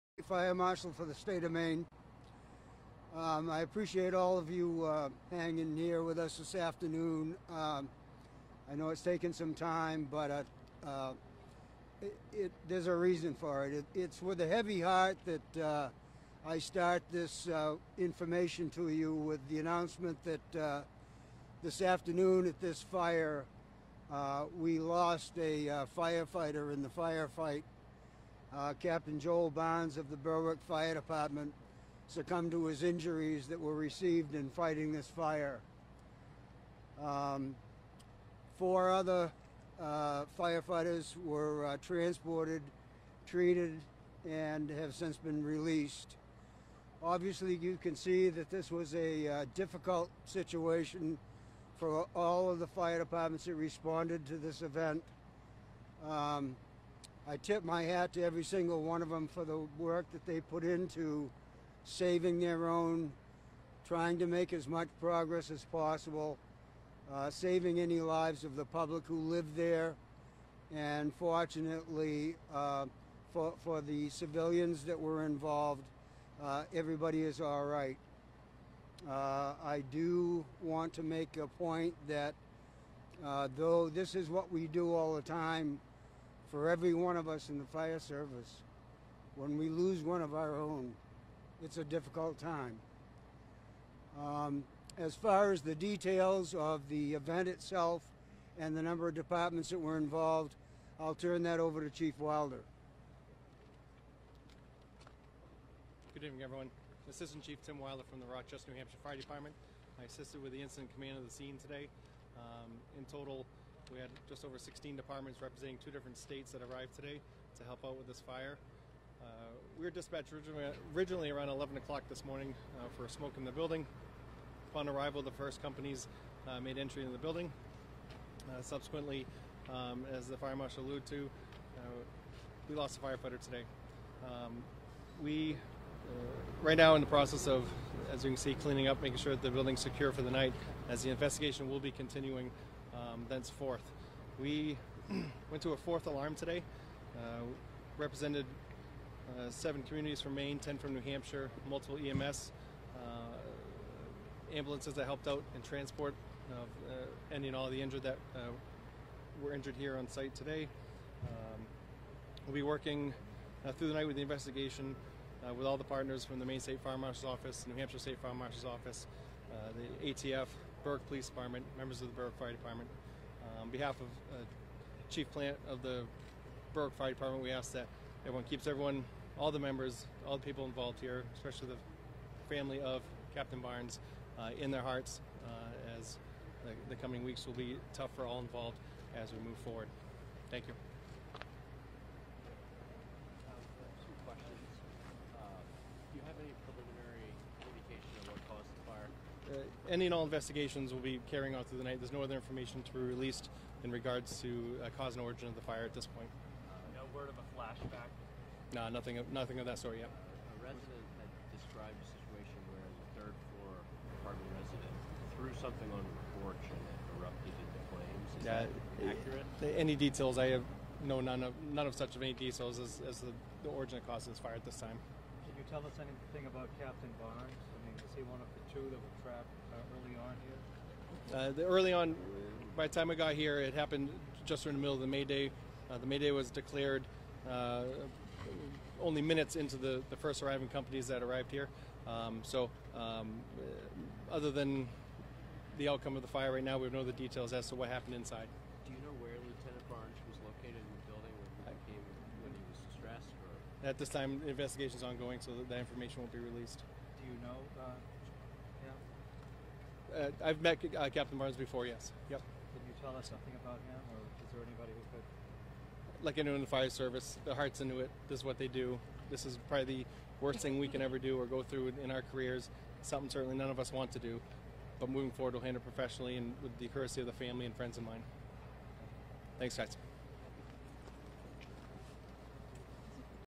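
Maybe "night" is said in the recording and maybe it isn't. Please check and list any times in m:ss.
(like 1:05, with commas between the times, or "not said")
2:20, 2:43, 3:21.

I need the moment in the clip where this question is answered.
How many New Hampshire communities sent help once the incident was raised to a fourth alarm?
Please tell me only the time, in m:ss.
2:30.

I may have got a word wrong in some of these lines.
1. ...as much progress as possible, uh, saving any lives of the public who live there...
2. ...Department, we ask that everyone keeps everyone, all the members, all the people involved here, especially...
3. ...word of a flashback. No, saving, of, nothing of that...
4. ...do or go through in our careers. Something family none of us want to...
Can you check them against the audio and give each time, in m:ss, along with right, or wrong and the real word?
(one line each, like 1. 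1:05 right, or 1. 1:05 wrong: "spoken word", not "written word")
1. 1:04 right
2. 2:57 right
3. 3:27 wrong: "nothing", not "saving"
4. 4:31 wrong: "certainly", not "family".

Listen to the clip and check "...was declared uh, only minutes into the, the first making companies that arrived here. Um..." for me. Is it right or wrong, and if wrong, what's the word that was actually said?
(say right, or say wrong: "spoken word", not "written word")
wrong: "arriving", not "making".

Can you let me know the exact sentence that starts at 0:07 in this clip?
Um, I know it's taken some time, but uh, uh, it, it, there's a reason for it.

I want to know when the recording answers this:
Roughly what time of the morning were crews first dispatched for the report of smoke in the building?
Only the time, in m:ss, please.
2:01.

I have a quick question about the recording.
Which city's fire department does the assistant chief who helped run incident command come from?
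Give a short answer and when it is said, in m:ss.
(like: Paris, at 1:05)
Rochester, New Hampshire, at 1:48.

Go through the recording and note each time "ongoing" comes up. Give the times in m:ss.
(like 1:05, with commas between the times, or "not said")
4:15.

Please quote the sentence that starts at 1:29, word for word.
When we lose one of our own, it's a difficult time.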